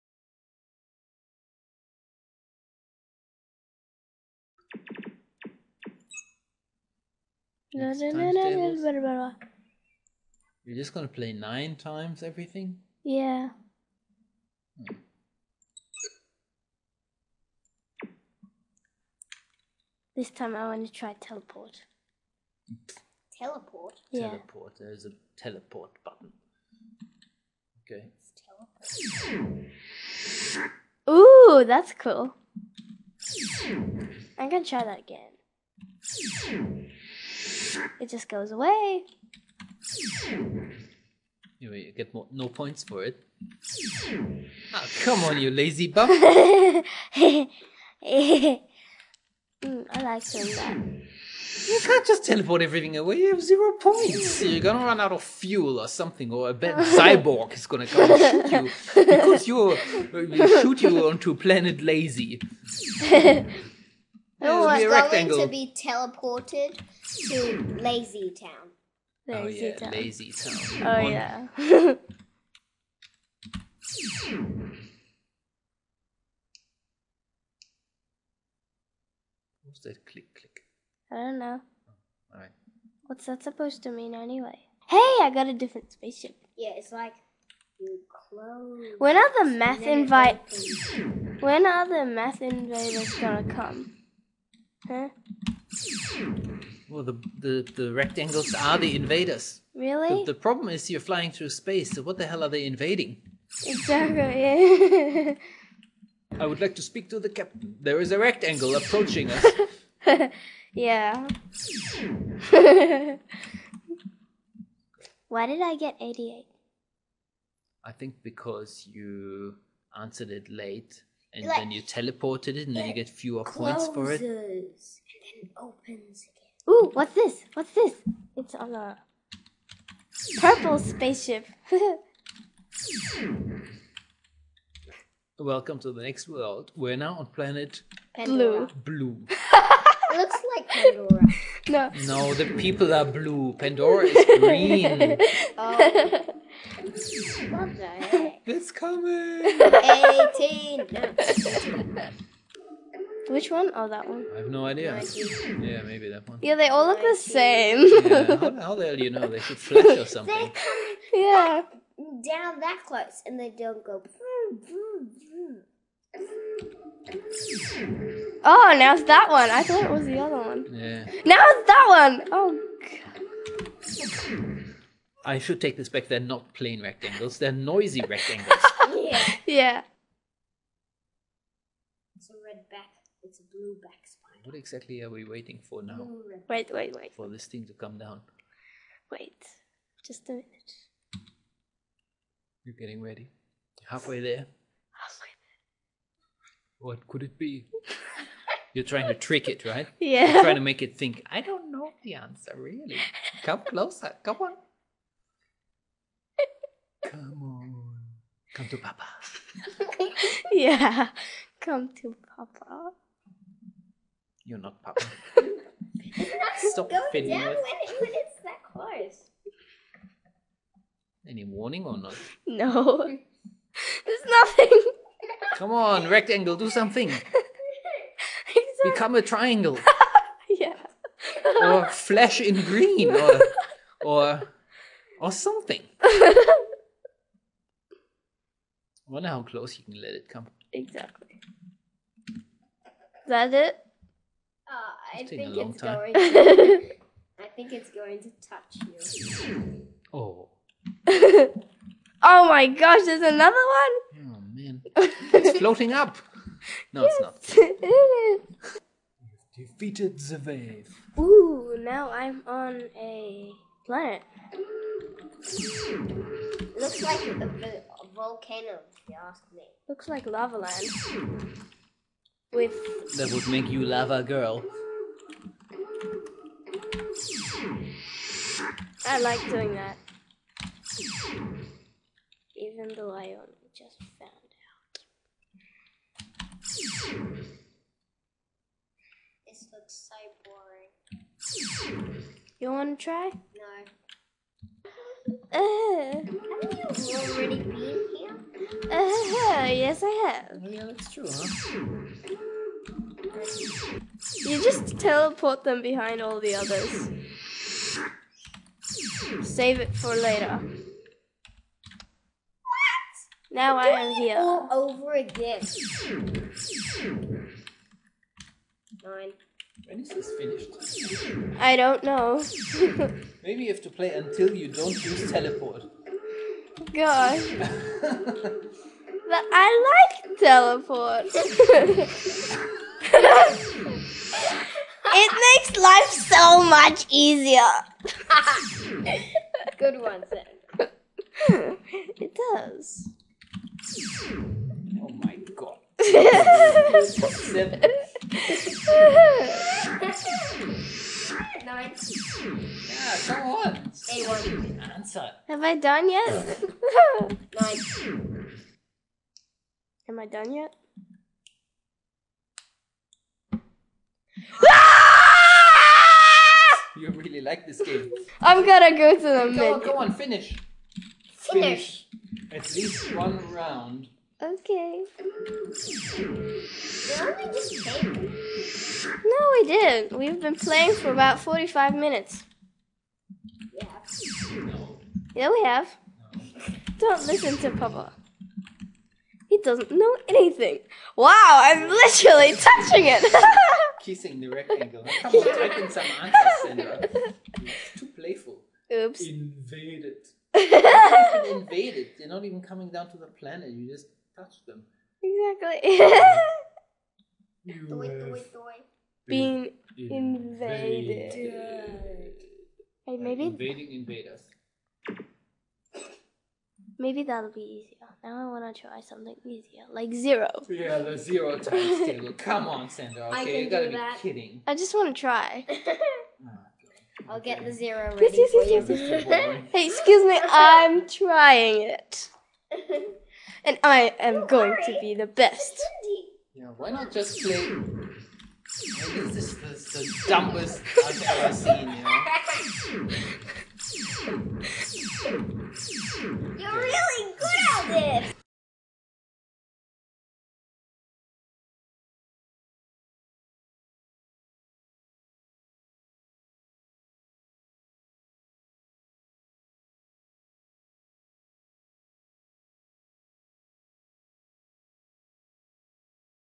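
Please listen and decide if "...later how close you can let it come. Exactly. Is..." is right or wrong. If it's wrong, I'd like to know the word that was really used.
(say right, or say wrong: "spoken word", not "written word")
wrong: "wonder", not "later".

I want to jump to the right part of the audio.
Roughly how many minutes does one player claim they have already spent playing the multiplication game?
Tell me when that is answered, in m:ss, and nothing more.
6:21.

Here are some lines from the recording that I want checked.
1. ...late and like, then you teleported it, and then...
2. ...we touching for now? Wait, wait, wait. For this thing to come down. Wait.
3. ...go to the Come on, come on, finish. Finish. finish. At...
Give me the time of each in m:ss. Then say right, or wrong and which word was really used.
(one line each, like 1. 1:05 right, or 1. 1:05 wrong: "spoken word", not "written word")
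1. 2:00 right
2. 3:05 wrong: "waiting", not "touching"
3. 6:08 right.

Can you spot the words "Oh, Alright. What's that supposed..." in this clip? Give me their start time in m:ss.
1:21.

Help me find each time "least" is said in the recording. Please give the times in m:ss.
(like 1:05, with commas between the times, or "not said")
6:12.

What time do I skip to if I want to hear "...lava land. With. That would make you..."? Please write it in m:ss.
4:30.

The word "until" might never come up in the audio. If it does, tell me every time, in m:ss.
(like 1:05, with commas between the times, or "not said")
5:24.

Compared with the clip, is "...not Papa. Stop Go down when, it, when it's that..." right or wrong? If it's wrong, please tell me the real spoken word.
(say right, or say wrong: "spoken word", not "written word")
right.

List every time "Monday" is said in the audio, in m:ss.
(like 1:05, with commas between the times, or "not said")
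not said.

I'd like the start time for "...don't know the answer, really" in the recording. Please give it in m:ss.
3:21.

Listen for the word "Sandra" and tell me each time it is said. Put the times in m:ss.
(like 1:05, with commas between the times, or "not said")
6:36, 7:02.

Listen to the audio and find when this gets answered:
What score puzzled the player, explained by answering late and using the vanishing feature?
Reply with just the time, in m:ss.
1:56.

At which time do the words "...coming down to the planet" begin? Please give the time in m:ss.
6:42.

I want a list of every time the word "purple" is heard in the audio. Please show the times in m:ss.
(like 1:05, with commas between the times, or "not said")
2:10.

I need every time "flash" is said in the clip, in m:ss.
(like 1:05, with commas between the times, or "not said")
2:39, 3:51.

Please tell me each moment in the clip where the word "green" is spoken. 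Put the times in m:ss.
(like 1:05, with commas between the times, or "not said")
2:24, 3:52.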